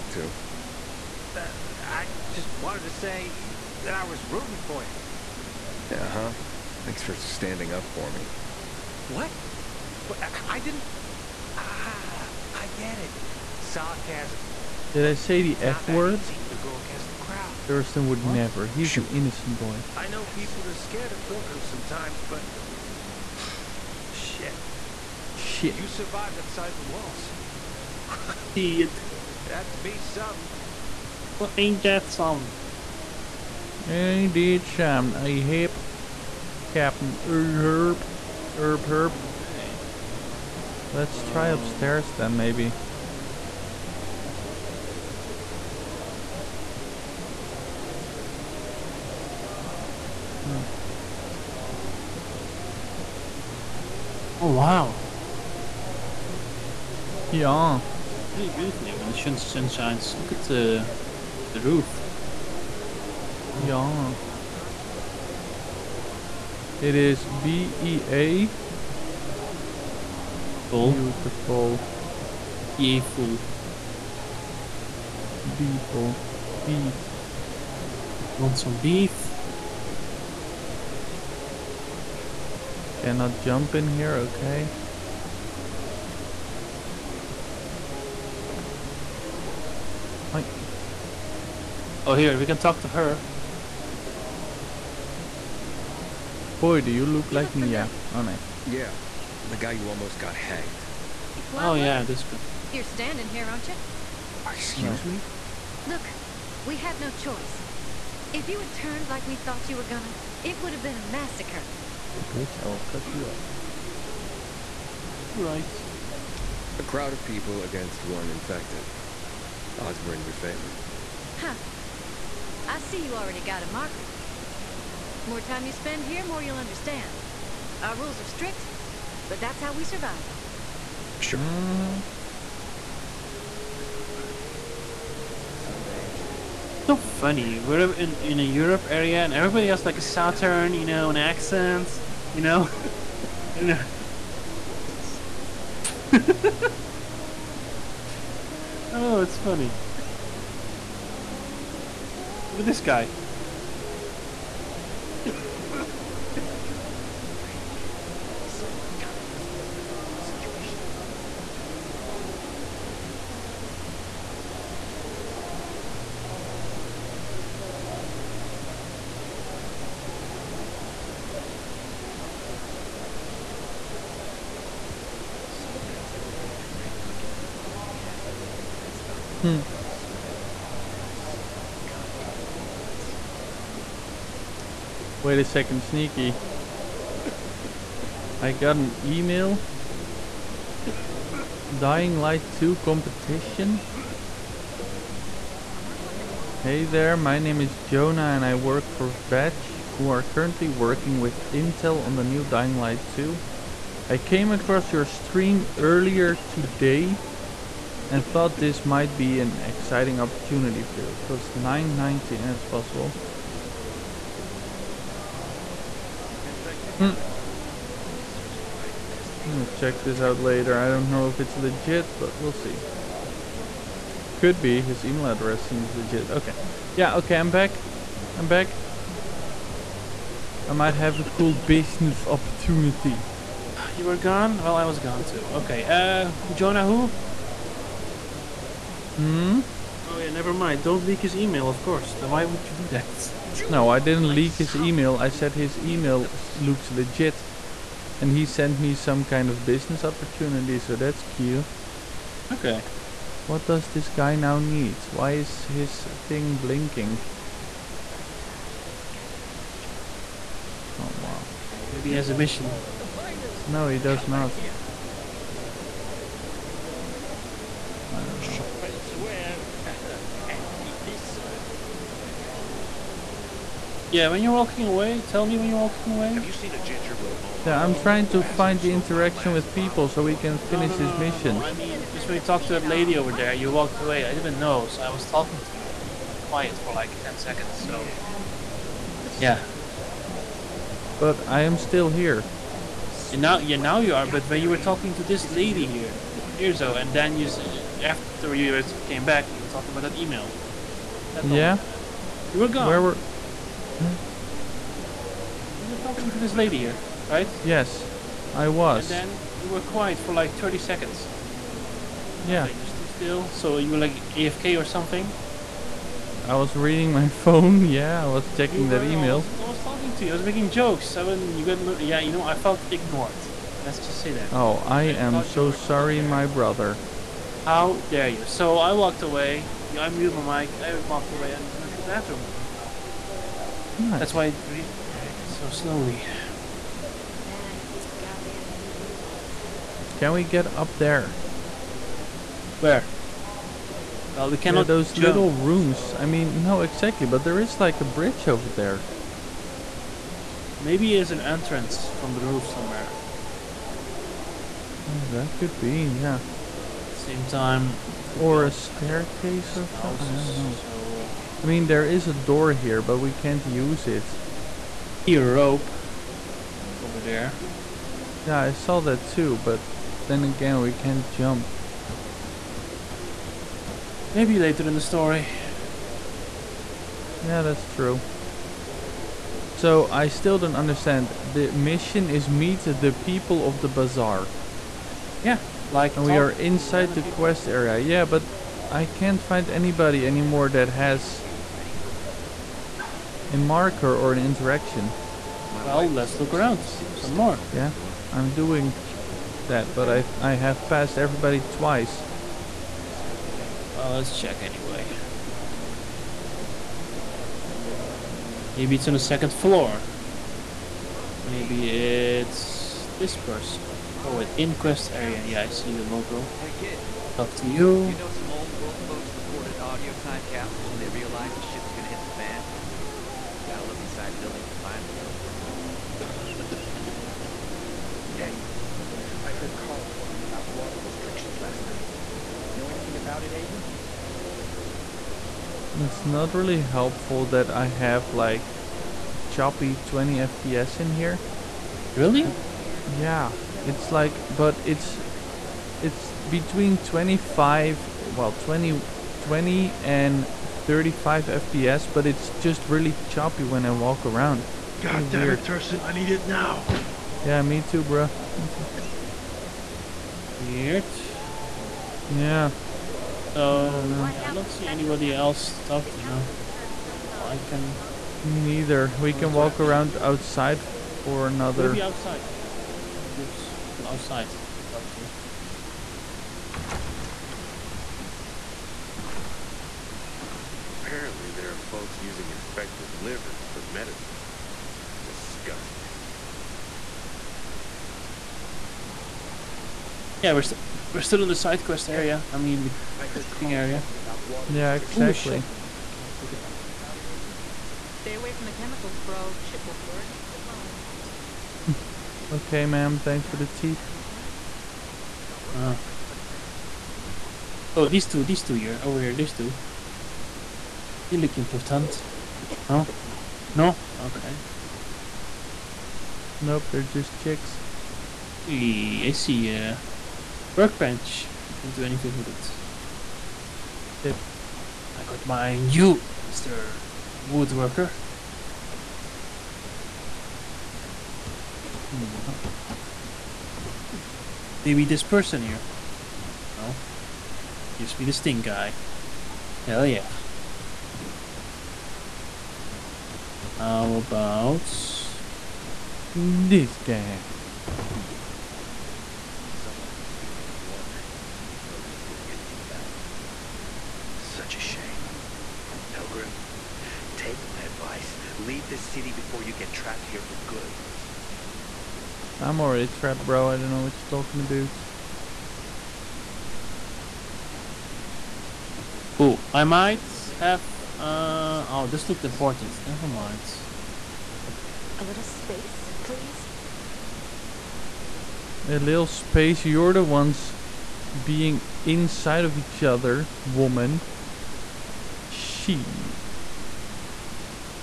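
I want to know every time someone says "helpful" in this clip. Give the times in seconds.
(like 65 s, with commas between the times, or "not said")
436 s.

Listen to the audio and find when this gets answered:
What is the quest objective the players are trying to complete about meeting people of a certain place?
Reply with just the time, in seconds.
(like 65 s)
382 s.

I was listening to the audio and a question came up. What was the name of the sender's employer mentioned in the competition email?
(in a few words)
Vetch.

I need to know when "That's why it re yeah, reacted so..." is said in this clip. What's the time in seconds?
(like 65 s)
334 s.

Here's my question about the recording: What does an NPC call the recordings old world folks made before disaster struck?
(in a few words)
Audio time capsules.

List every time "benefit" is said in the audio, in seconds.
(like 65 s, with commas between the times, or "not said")
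not said.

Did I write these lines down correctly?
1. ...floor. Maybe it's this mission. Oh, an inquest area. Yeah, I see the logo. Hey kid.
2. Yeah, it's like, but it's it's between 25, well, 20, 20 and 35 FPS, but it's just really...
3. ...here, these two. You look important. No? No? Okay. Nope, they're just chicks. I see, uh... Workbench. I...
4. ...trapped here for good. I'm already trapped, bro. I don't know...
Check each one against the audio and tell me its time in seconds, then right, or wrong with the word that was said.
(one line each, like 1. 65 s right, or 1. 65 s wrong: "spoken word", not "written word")
1. 409 s wrong: "person", not "mission"
2. 443 s right
3. 509 s right
4. 559 s right.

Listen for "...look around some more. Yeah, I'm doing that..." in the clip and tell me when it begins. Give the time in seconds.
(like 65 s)
396 s.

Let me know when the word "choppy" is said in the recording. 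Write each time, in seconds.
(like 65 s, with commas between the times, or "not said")
439 s, 453 s.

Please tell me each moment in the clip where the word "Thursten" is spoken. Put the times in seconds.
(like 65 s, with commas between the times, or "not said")
17 s, 455 s.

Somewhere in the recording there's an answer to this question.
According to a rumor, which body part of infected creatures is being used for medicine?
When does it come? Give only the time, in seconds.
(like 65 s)
482 s.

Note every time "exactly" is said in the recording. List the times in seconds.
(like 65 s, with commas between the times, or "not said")
346 s, 494 s.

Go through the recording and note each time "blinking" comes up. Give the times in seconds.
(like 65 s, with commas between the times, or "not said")
256 s.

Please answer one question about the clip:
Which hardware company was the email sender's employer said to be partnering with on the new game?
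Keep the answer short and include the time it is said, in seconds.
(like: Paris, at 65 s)
Intel, at 200 s.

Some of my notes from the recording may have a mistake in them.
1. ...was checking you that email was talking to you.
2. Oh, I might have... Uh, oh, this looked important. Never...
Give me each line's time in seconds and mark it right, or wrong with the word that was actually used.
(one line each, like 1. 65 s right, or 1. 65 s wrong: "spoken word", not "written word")
1. 318 s right
2. 569 s right.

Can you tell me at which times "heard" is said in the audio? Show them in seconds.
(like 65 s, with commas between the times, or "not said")
429 s, 493 s.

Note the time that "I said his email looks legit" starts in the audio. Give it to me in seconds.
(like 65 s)
245 s.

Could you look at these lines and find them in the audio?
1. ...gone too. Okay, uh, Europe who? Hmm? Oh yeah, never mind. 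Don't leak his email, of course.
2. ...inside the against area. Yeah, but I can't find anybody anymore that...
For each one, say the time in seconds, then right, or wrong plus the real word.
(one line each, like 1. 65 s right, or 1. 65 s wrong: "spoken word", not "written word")
1. 234 s wrong: "Jonah", not "Europe"
2. 386 s wrong: "quest", not "against".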